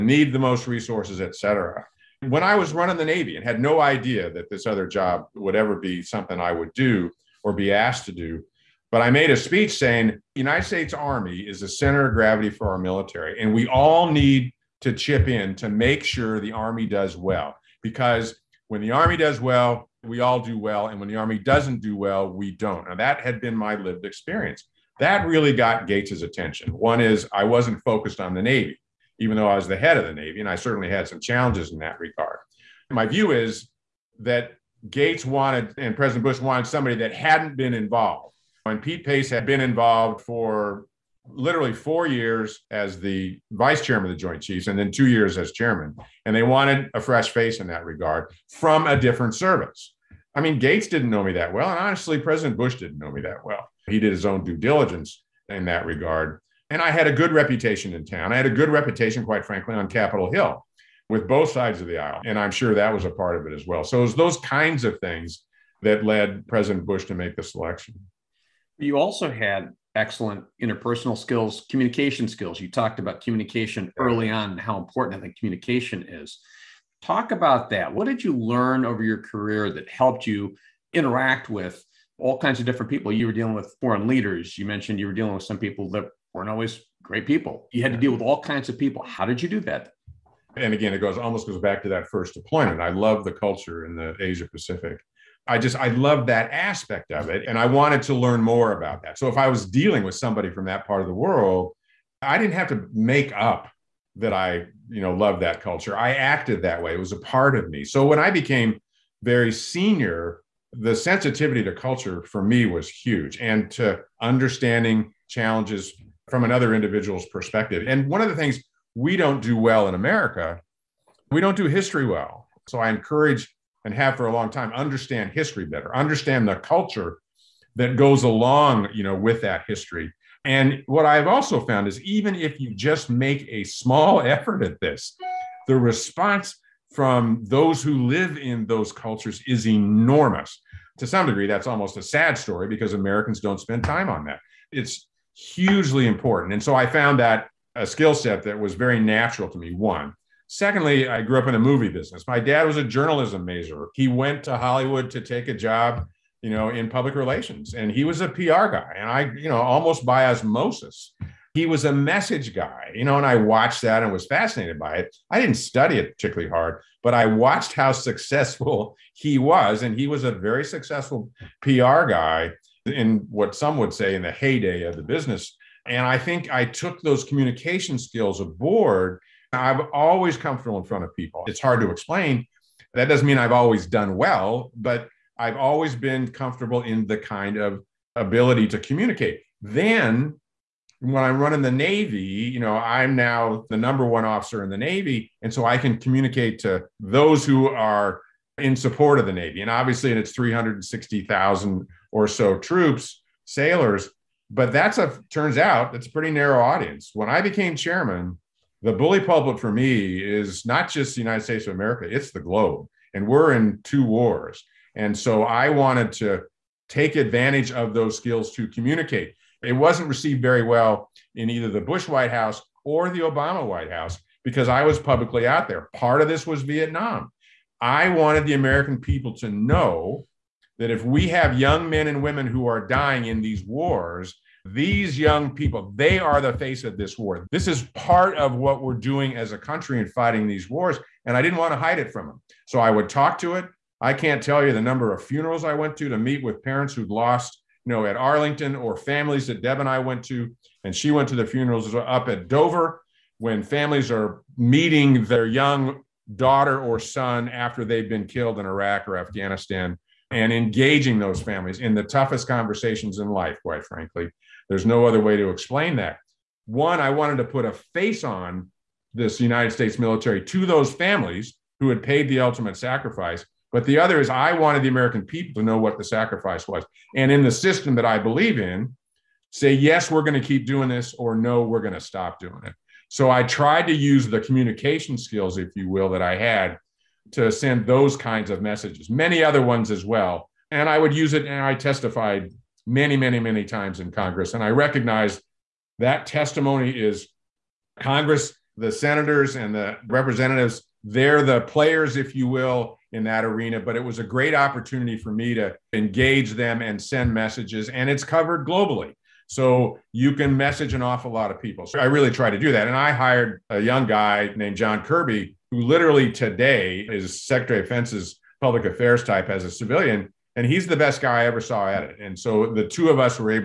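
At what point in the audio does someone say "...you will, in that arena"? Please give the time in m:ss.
5:02.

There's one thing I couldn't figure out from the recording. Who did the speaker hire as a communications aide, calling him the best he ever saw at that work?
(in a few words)
John Kirby.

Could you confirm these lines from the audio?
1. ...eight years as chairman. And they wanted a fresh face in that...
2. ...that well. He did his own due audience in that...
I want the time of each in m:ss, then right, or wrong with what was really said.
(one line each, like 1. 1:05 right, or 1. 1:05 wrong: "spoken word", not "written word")
1. 0:44 wrong: "two", not "eight"
2. 0:53 wrong: "diligence", not "audience".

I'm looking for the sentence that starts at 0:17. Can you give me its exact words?
Because when the Army does well, we all do well, and when the Army doesn't do well, we don't.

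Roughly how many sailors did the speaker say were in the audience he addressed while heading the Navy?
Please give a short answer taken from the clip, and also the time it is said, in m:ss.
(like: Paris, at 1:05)
360,000, at 3:20.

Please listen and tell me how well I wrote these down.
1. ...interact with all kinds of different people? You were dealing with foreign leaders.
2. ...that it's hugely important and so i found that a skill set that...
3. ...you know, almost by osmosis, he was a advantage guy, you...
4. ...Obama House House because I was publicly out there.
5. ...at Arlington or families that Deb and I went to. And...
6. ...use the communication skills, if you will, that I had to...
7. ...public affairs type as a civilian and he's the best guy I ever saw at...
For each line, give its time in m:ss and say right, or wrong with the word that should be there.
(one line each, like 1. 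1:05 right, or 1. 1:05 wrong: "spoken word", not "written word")
1. 1:20 right
2. 2:24 right
3. 2:39 wrong: "message", not "advantage"
4. 3:43 wrong: "White", not "House"
5. 4:08 right
6. 4:43 right
7. 5:18 right.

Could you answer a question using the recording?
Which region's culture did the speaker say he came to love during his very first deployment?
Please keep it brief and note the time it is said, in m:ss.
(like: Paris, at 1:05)
Asia Pacific, at 1:34.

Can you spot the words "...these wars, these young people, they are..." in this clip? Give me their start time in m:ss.
3:53.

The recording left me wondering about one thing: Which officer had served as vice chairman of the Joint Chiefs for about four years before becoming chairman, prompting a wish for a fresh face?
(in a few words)
Pete Pace.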